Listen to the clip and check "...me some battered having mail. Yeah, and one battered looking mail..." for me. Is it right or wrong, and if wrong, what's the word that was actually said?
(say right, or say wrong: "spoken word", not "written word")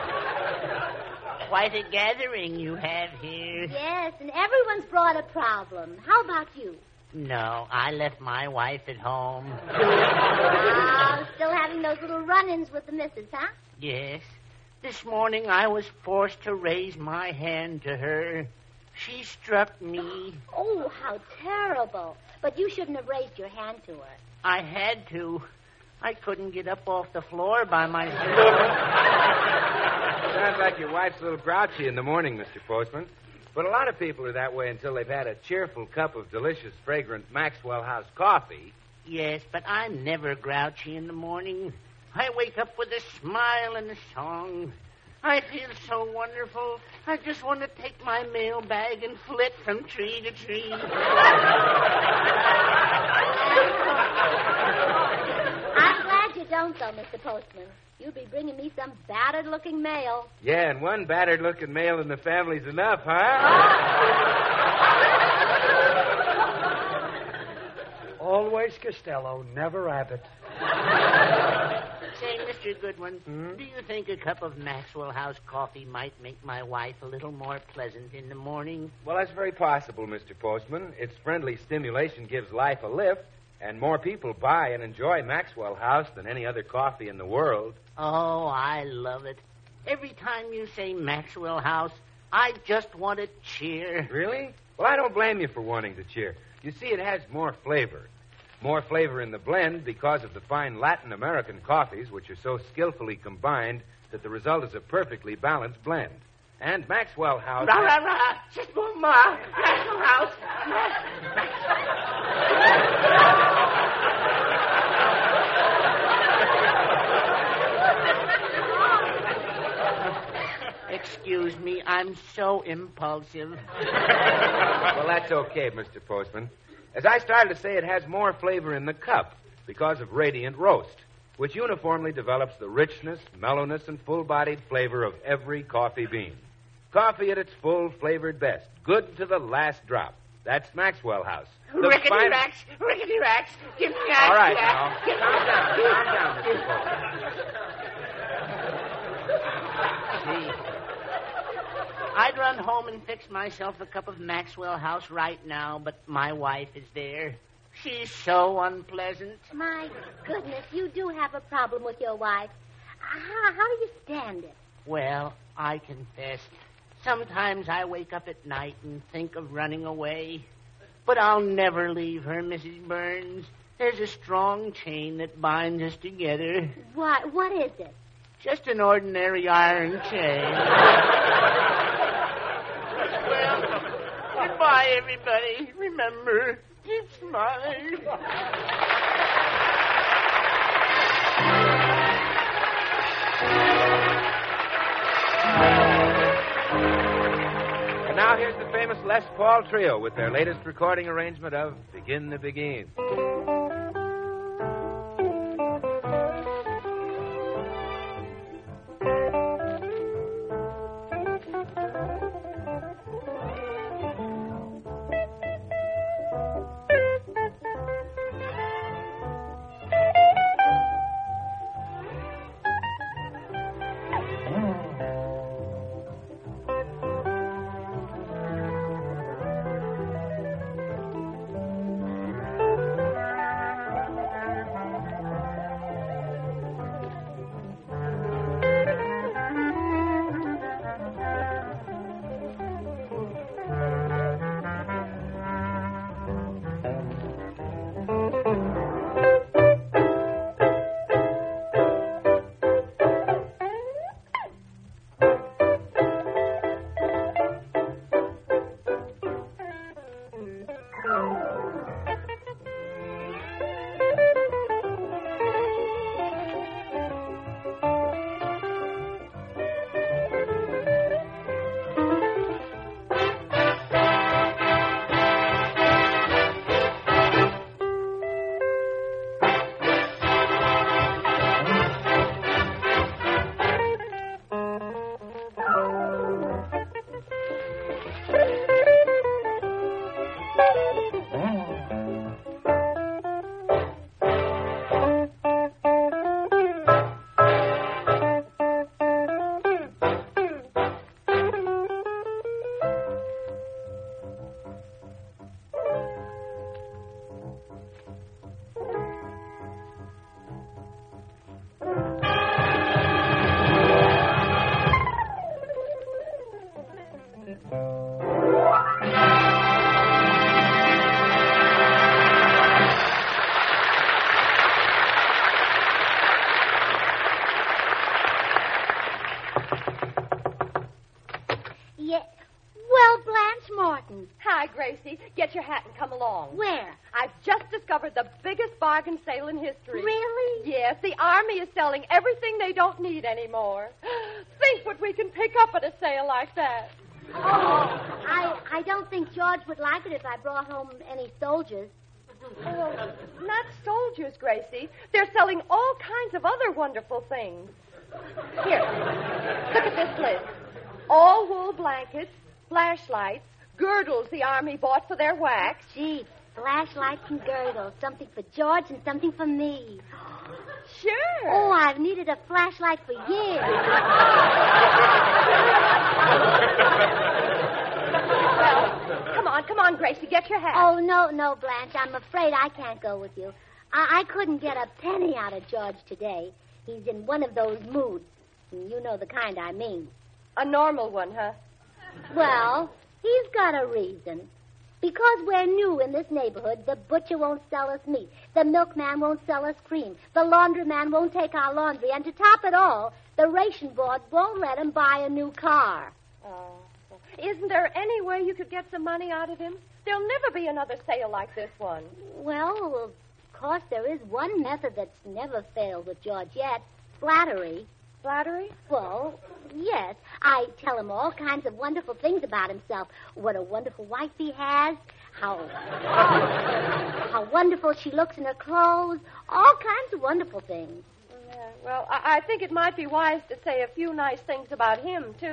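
wrong: "looking", not "having".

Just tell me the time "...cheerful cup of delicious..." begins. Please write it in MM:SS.
00:35.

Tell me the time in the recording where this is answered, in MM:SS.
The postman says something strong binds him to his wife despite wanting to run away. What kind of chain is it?
02:58.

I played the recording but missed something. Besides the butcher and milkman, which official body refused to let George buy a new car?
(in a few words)
the ration board.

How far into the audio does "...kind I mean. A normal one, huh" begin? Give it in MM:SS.
06:29.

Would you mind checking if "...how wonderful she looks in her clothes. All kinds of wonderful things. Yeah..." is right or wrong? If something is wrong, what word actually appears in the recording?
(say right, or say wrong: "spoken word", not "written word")
right.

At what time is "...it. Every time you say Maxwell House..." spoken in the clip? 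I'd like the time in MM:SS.
01:29.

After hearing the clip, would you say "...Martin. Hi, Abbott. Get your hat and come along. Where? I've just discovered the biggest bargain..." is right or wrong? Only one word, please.
wrong.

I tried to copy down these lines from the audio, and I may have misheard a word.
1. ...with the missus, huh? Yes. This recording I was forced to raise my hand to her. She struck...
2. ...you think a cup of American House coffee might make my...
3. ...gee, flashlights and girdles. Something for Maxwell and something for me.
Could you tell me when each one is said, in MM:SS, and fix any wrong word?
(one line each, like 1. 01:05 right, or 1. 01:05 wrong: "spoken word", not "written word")
1. 00:12 wrong: "morning", not "recording"
2. 01:13 wrong: "Maxwell", not "American"
3. 06:05 wrong: "George", not "Maxwell".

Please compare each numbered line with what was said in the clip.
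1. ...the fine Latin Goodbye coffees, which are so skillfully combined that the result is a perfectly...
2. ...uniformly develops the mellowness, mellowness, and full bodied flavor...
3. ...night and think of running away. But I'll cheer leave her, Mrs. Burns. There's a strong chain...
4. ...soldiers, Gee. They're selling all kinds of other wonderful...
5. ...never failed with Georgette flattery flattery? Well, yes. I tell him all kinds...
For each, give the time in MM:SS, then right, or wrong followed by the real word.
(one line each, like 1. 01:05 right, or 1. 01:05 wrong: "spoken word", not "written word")
1. 01:40 wrong: "American", not "Goodbye"
2. 02:11 wrong: "richness", not "mellowness"
3. 02:48 wrong: "never", not "cheer"
4. 05:53 wrong: "Gracie", not "Gee"
5. 06:55 right.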